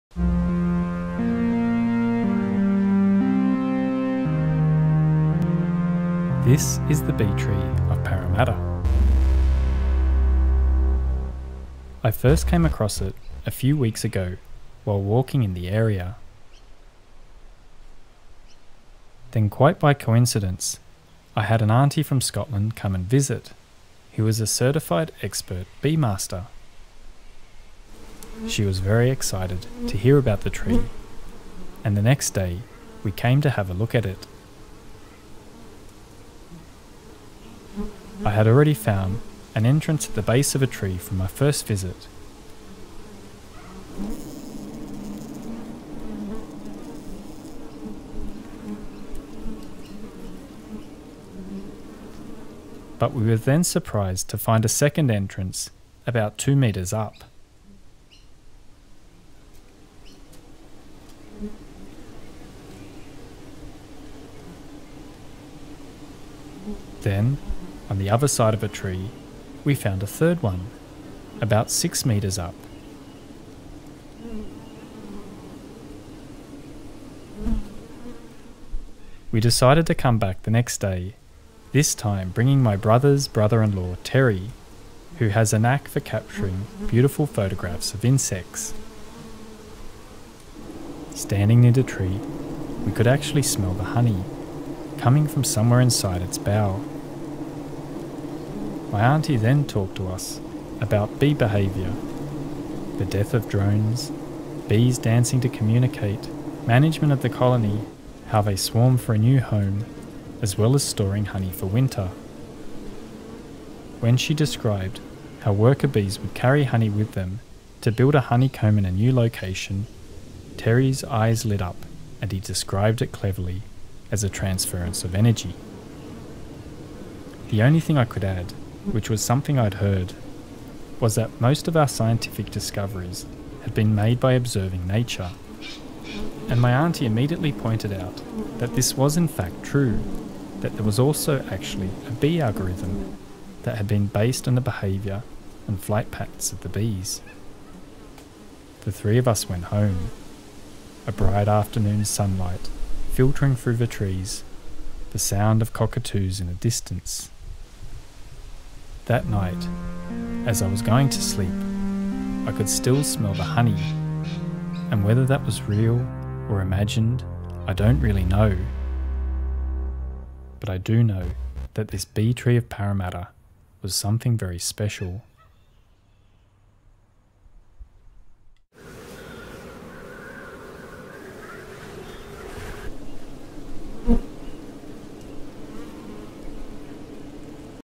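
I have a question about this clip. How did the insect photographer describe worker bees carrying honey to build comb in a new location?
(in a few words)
a transference of energy.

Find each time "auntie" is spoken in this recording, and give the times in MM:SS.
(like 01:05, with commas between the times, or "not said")
00:21, 01:39, 02:16.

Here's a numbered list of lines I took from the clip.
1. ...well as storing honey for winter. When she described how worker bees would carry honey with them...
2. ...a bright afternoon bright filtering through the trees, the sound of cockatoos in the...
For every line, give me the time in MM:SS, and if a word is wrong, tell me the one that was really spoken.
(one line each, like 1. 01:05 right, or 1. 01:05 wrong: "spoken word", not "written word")
1. 01:50 right
2. 02:31 wrong: "sunlight", not "bright".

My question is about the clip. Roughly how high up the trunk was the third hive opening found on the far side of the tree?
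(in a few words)
6 metres.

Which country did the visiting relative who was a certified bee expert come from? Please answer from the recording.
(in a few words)
Scotland.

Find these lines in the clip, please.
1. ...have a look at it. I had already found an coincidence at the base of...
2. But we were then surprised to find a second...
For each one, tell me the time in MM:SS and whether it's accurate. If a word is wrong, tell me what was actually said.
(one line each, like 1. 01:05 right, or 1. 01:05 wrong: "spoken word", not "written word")
1. 00:33 wrong: "entrance", not "coincidence"
2. 00:52 right.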